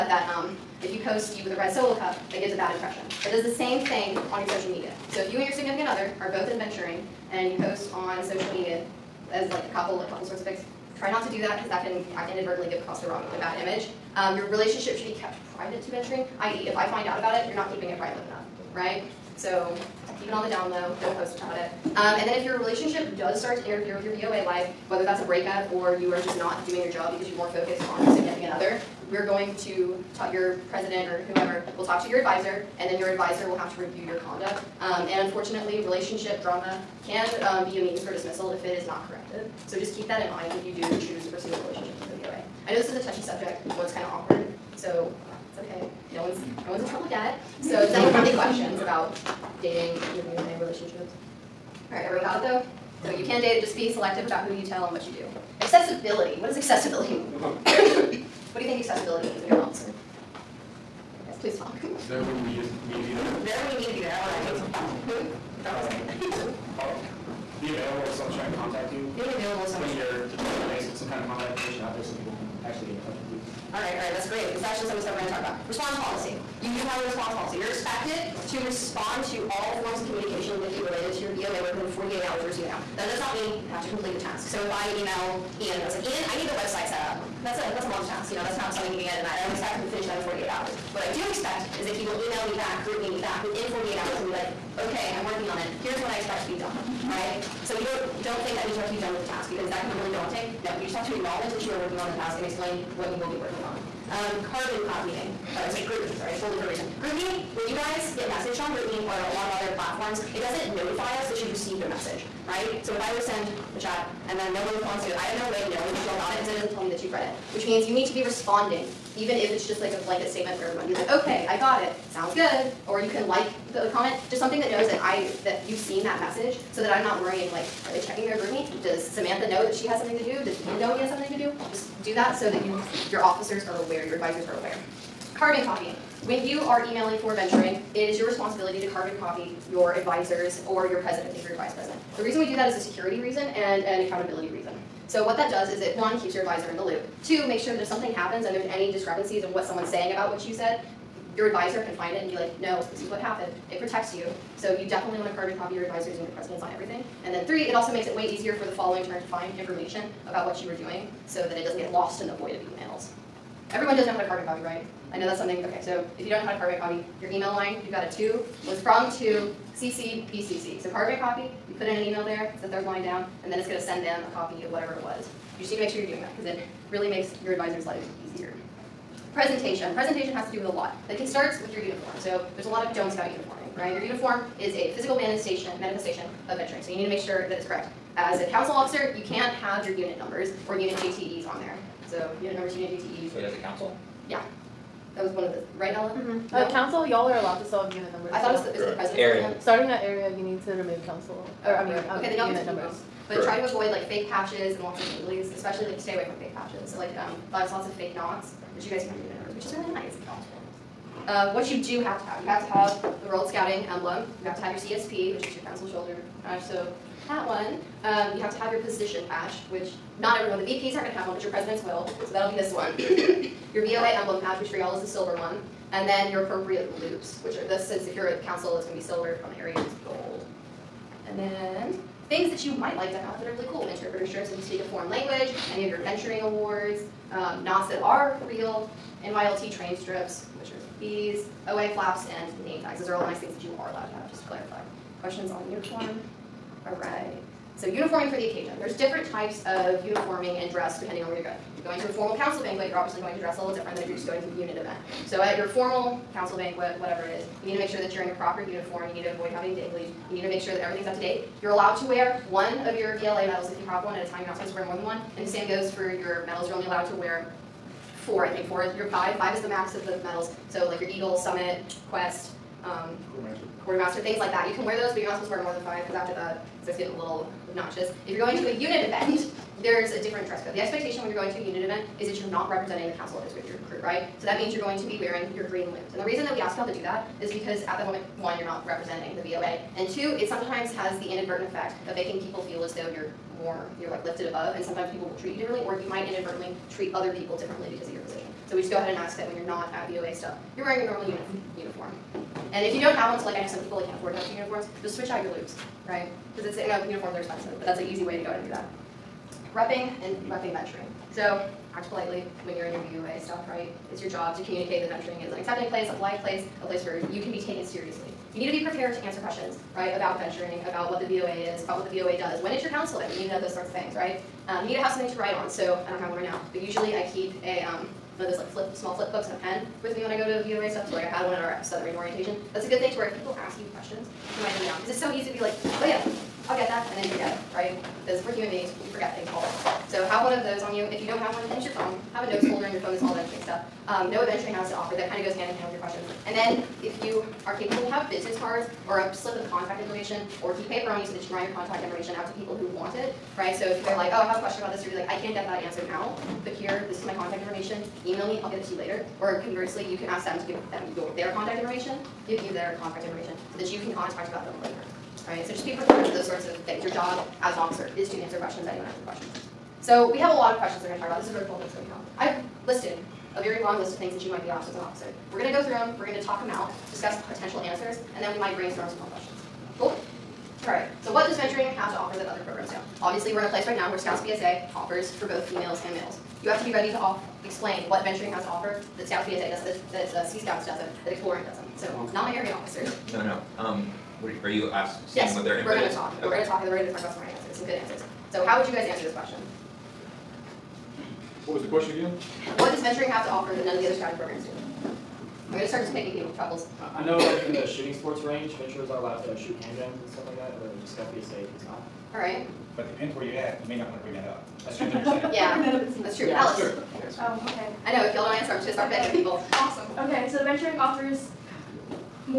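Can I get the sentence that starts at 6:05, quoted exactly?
So just be prepared for those sorts of things.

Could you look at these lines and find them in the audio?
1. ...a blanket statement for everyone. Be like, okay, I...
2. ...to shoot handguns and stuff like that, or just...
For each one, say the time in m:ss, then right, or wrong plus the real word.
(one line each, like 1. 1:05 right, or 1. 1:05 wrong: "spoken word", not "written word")
1. 1:59 right
2. 6:49 right.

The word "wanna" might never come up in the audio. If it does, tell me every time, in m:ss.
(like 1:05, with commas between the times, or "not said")
6:54.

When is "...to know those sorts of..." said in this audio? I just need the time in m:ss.
5:23.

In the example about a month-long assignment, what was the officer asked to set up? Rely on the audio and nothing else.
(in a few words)
the website.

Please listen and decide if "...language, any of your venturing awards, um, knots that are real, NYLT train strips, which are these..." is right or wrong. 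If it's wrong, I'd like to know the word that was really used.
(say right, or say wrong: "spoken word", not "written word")
right.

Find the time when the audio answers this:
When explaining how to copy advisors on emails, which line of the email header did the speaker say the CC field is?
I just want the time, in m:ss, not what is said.
2:52.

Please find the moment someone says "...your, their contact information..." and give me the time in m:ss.
6:01.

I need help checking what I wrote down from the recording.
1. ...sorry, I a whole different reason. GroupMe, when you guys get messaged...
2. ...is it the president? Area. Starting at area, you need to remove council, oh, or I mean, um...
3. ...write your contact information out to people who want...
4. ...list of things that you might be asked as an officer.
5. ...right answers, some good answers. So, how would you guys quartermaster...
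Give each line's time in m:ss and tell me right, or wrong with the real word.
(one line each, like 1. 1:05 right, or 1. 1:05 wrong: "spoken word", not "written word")
1. 1:46 right
2. 3:18 right
3. 5:51 right
4. 6:13 right
5. 6:37 wrong: "answer", not "quartermaster".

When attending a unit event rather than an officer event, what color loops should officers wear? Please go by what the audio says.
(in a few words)
green.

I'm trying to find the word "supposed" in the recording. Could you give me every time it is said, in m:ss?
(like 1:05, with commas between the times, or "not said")
4:24, 4:35.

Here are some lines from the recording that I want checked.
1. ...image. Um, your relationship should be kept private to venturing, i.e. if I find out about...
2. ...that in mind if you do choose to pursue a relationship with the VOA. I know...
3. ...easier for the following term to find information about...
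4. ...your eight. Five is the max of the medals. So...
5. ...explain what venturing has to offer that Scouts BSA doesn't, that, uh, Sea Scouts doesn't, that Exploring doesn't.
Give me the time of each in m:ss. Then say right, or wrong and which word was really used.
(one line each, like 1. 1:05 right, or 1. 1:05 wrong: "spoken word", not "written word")
1. 0:13 right
2. 0:40 right
3. 2:38 right
4. 4:28 wrong: "five", not "eight"
5. 6:27 right.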